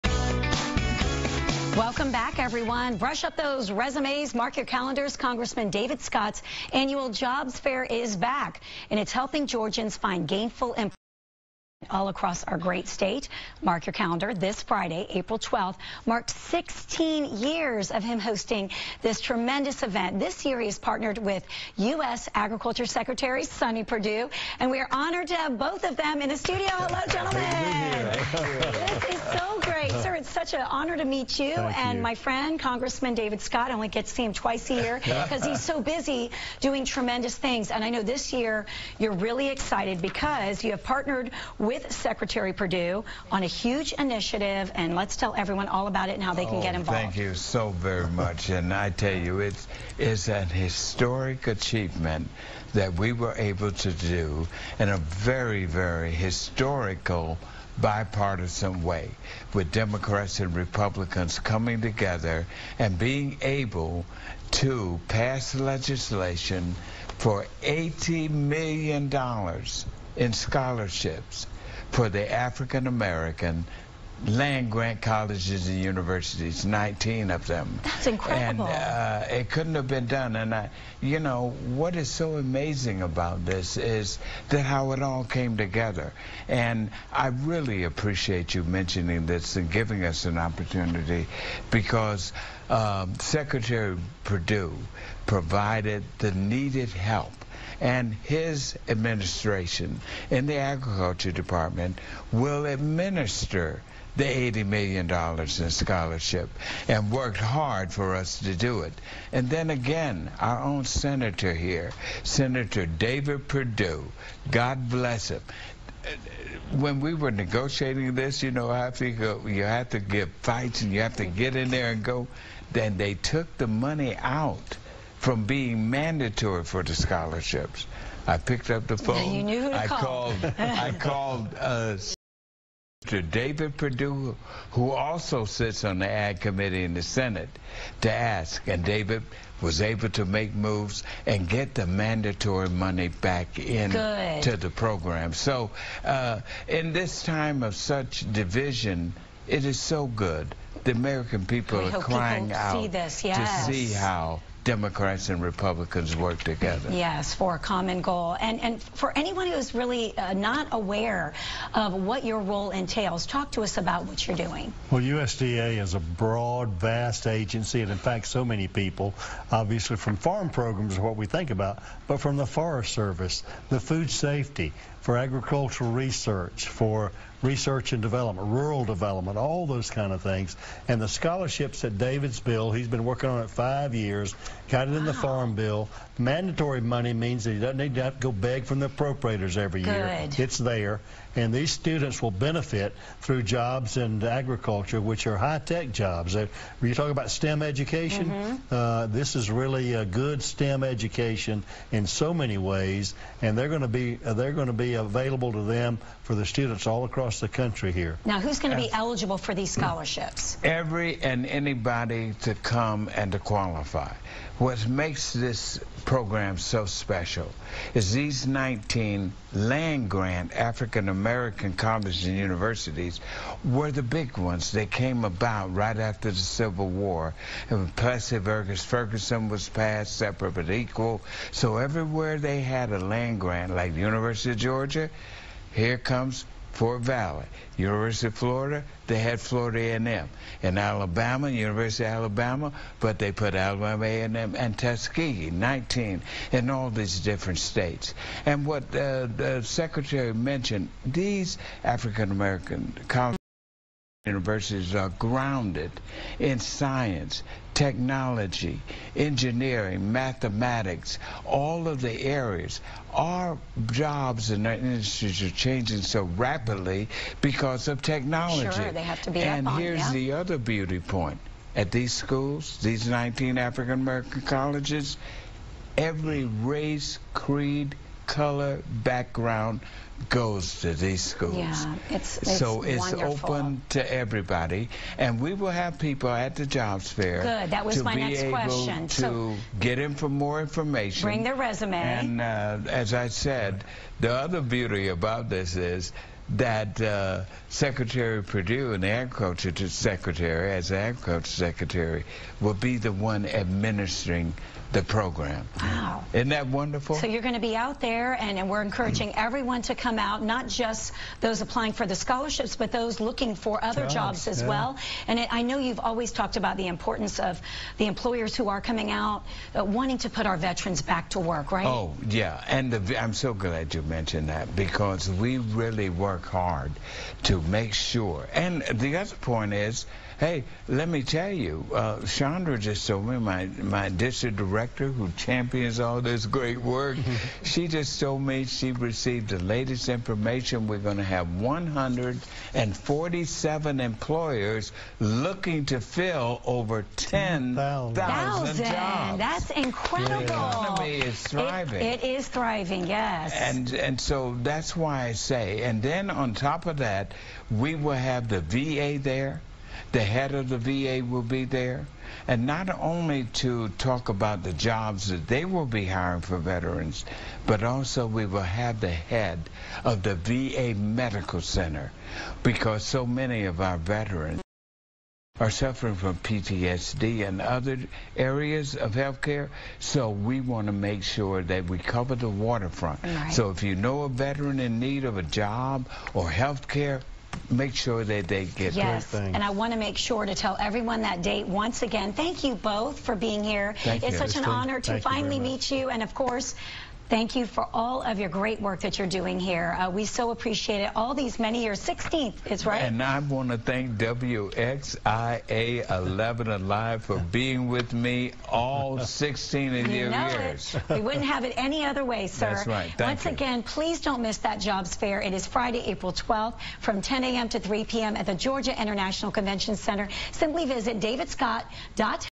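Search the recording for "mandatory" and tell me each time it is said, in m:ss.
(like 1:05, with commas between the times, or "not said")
2:05, 2:21, 3:06.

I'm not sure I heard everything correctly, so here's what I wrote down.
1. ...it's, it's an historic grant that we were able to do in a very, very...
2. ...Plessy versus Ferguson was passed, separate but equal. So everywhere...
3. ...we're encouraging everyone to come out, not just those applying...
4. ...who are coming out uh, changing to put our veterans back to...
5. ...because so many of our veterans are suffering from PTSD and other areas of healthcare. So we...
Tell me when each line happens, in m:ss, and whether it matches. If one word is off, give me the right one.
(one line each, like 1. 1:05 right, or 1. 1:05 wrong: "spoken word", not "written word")
1. 0:49 wrong: "achievement", not "grant"
2. 3:47 right
3. 5:08 right
4. 5:18 wrong: "wanting", not "changing"
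5. 6:12 right.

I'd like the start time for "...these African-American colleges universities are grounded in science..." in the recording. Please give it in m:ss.
4:11.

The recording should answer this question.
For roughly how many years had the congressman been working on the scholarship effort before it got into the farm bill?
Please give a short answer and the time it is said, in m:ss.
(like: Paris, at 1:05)
5 years, at 3:03.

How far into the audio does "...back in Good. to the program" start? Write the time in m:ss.
2:23.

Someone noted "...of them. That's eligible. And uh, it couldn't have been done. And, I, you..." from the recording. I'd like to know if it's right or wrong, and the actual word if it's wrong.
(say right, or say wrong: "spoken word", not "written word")
wrong: "incredible", not "eligible".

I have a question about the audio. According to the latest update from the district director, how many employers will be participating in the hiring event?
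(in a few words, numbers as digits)
147.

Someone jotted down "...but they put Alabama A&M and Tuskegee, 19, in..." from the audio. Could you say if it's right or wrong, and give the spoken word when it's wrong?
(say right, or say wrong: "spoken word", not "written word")
right.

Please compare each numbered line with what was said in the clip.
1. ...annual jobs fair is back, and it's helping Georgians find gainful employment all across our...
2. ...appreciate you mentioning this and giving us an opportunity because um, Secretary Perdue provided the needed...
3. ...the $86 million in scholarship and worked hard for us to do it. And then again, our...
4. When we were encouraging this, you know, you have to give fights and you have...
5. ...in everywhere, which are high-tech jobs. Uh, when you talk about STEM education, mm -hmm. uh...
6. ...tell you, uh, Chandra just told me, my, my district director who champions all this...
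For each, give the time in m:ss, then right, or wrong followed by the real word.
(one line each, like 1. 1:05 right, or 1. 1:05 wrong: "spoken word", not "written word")
1. 0:06 right
2. 1:27 right
3. 1:44 wrong: "80", not "86"
4. 1:56 wrong: "negotiating", not "encouraging"
5. 3:13 wrong: "agriculture", not "everywhere"
6. 5:31 right.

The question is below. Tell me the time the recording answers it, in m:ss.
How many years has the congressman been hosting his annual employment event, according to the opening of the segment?
0:16.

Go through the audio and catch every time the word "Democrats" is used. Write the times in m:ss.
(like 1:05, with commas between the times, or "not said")
0:59, 2:34.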